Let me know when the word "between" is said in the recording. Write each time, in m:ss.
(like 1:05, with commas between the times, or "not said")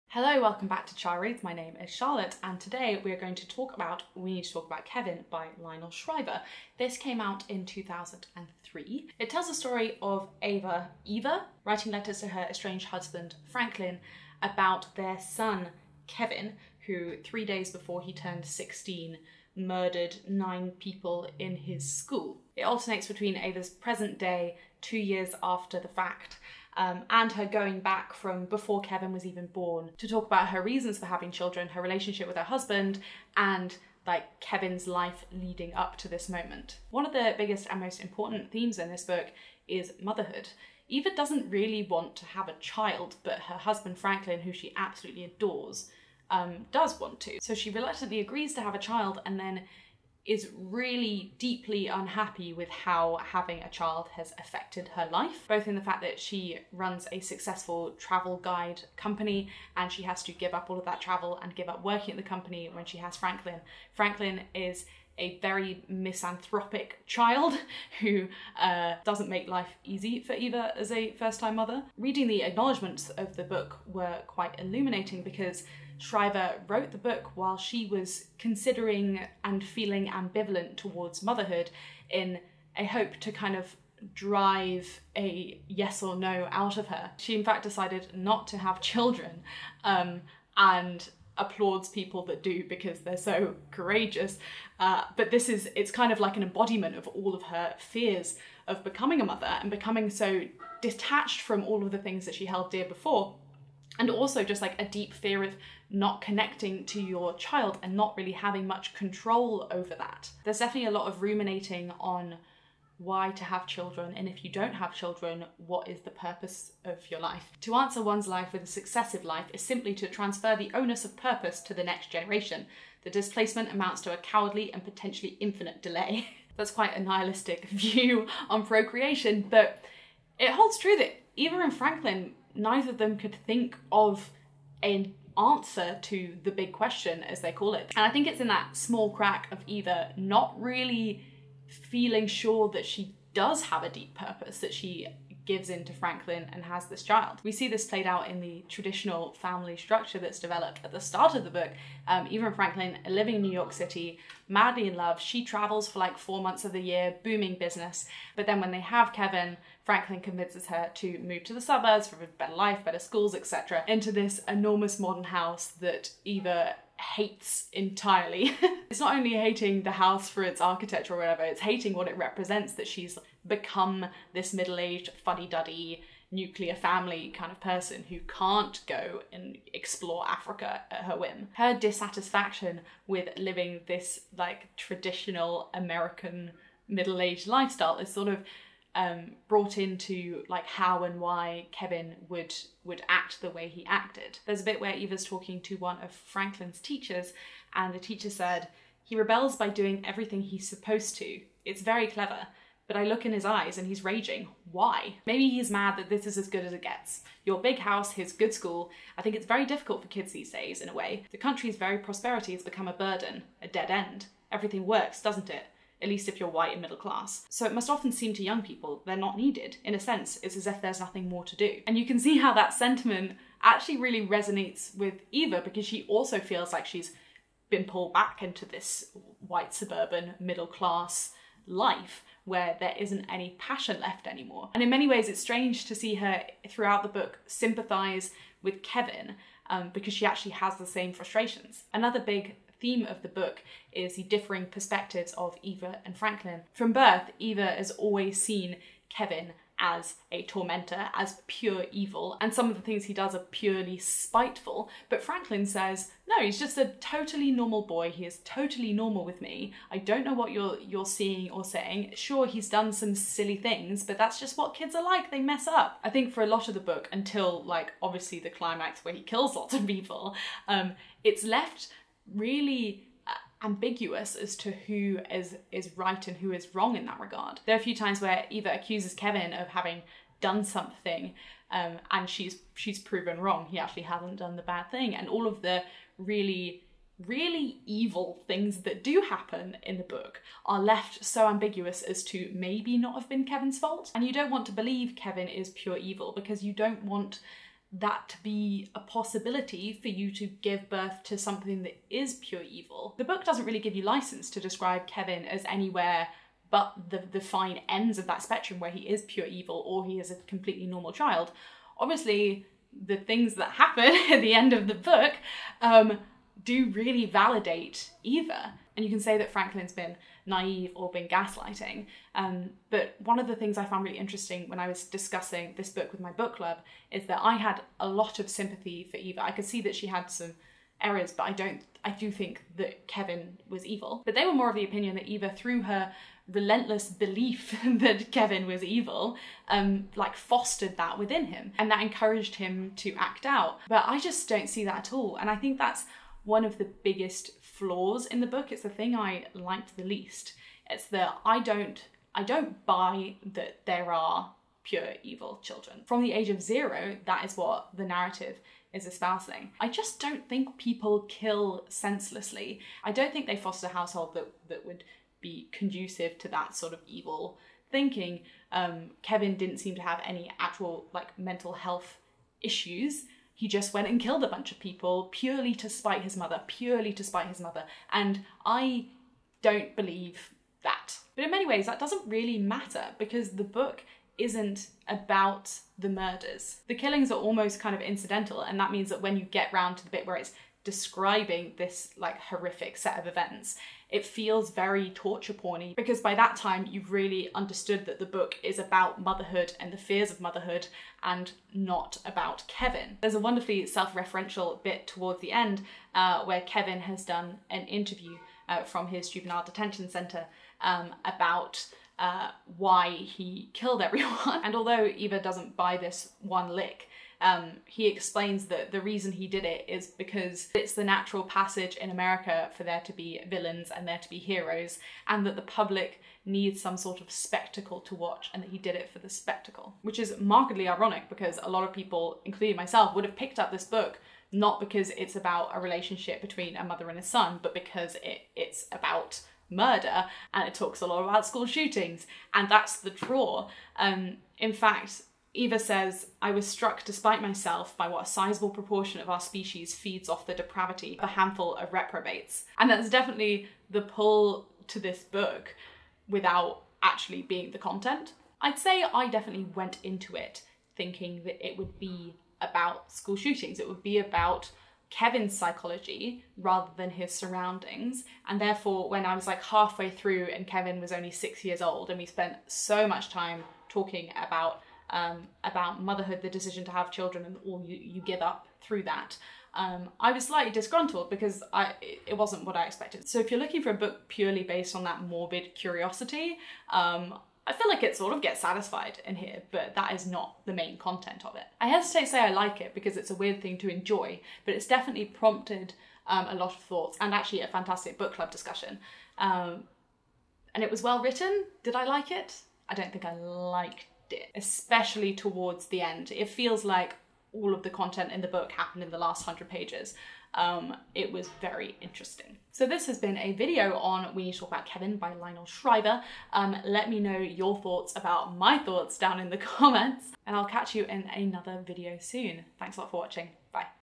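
0:23, 7:16.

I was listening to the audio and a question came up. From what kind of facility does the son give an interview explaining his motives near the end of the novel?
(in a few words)
Juvenile detention centre.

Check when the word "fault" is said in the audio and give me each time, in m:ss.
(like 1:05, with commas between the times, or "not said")
4:53.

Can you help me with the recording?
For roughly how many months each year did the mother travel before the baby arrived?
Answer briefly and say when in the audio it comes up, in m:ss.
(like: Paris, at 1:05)
4 months, at 2:36.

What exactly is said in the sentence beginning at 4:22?
Sure, he's done some silly things, but that's just what kids are like.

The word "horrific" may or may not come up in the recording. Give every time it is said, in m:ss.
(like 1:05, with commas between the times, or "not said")
6:32.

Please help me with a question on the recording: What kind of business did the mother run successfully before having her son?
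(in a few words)
Travel guide company.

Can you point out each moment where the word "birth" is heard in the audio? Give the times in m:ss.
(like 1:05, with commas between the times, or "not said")
4:06, 5:00.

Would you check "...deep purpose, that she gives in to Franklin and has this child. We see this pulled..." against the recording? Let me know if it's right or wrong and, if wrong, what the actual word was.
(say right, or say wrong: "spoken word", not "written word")
wrong: "played", not "pulled".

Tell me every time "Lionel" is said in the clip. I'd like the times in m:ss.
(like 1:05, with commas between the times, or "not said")
0:05, 8:35.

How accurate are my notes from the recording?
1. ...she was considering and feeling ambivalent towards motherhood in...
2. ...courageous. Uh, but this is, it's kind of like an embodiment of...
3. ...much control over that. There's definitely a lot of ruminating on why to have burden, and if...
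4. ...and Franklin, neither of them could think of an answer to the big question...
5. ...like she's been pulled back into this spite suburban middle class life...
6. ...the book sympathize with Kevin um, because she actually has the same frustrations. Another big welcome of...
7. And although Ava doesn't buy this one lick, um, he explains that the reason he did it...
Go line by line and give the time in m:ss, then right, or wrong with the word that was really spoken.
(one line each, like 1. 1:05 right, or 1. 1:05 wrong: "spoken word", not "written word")
1. 1:17 right
2. 1:33 right
3. 1:48 wrong: "children", not "burden"
4. 2:11 right
5. 3:46 wrong: "white", not "spite"
6. 3:57 wrong: "theme", not "welcome"
7. 6:54 wrong: "Eva", not "Ava".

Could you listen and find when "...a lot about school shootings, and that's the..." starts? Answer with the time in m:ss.
7:20.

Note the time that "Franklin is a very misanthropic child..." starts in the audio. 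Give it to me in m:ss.
1:03.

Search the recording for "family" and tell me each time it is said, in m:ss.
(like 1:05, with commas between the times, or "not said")
2:29, 2:56.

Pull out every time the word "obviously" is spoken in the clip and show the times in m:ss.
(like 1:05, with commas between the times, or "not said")
4:28, 5:11.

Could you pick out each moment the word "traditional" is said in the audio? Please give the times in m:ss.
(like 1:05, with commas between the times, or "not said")
2:28, 3:04.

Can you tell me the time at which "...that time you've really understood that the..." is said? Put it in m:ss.
6:36.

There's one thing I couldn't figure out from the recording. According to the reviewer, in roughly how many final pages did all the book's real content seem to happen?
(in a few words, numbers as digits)
100.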